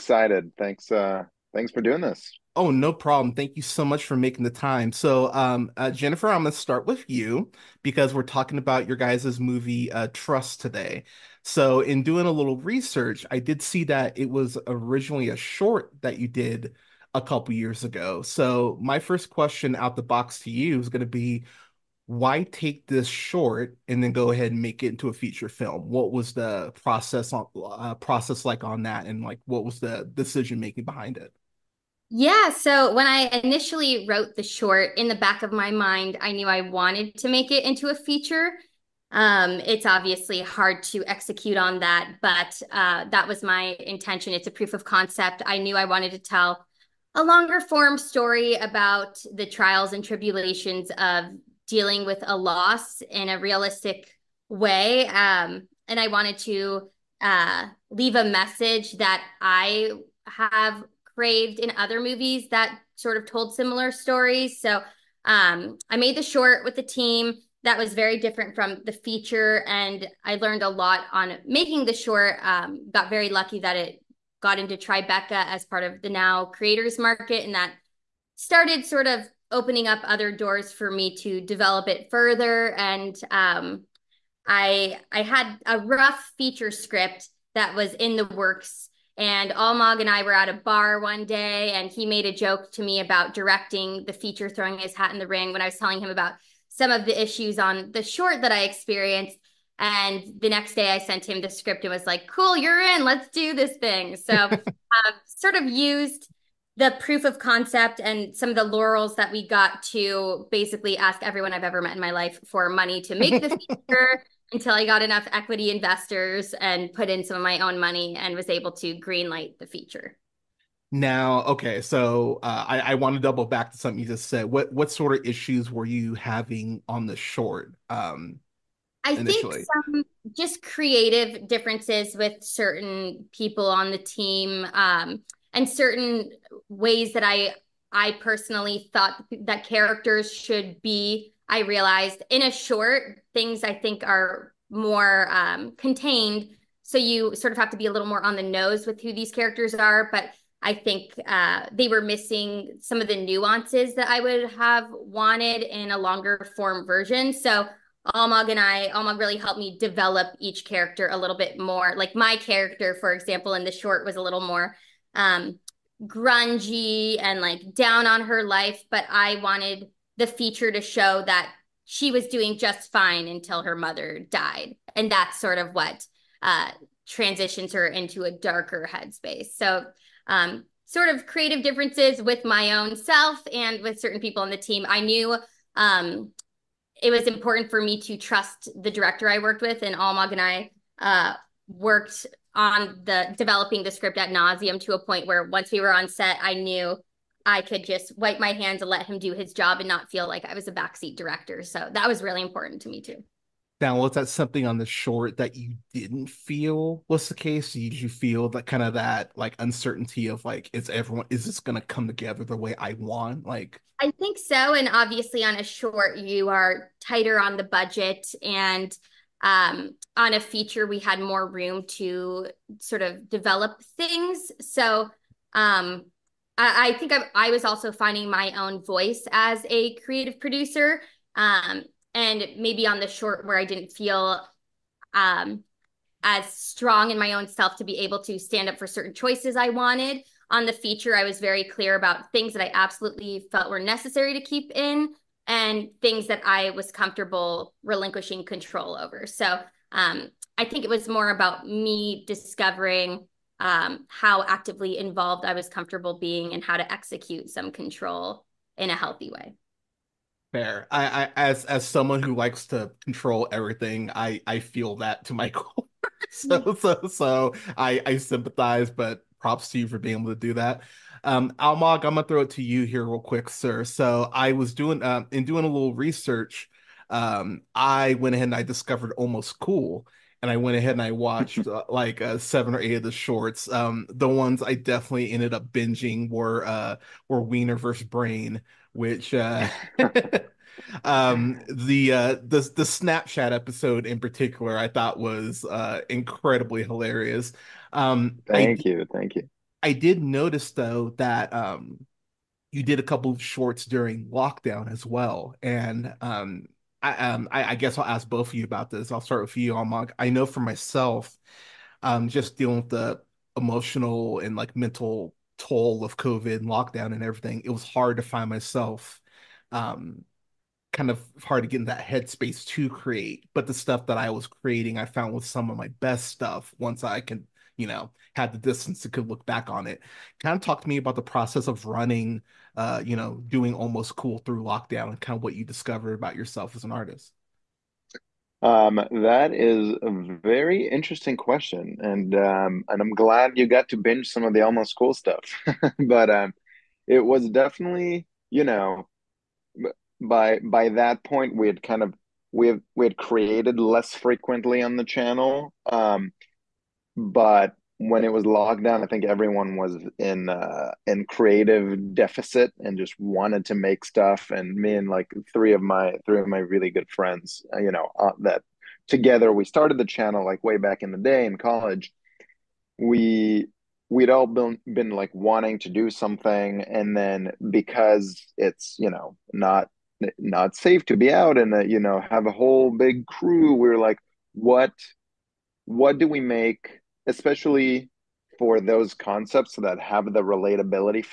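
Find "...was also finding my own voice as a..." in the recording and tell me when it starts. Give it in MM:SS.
03:47.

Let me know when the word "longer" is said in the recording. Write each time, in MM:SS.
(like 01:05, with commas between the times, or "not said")
00:47, 02:35.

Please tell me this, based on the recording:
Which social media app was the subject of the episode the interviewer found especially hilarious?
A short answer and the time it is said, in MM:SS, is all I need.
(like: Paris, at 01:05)
Snapchat, at 04:52.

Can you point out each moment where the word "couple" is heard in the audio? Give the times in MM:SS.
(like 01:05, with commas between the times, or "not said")
00:17, 05:03.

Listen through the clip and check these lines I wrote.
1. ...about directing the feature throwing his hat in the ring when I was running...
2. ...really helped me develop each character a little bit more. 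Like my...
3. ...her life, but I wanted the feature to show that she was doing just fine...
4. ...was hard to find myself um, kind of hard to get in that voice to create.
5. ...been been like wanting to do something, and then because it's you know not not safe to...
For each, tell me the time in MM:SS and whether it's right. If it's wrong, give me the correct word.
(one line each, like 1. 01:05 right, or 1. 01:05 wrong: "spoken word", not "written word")
1. 01:32 wrong: "telling", not "running"
2. 02:39 right
3. 02:48 right
4. 05:17 wrong: "headspace", not "voice"
5. 06:14 right.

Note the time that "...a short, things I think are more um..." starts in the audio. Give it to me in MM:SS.
02:22.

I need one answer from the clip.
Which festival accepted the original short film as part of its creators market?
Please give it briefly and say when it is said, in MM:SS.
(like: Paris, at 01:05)
Tribeca, at 01:14.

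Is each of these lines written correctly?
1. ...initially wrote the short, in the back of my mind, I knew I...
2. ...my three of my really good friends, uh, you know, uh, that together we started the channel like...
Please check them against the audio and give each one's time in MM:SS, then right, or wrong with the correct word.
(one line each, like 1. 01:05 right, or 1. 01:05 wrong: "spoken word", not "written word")
1. 00:33 right
2. 06:05 right.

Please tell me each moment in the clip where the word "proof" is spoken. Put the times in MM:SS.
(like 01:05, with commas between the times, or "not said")
00:44, 01:46.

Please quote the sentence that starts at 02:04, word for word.
What what sort of issues were you having on the short?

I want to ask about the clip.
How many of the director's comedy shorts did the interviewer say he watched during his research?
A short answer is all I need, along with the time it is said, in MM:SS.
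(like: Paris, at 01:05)
7 or 8, at 04:42.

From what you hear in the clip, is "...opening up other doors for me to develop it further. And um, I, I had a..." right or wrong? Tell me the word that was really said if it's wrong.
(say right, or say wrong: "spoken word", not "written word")
right.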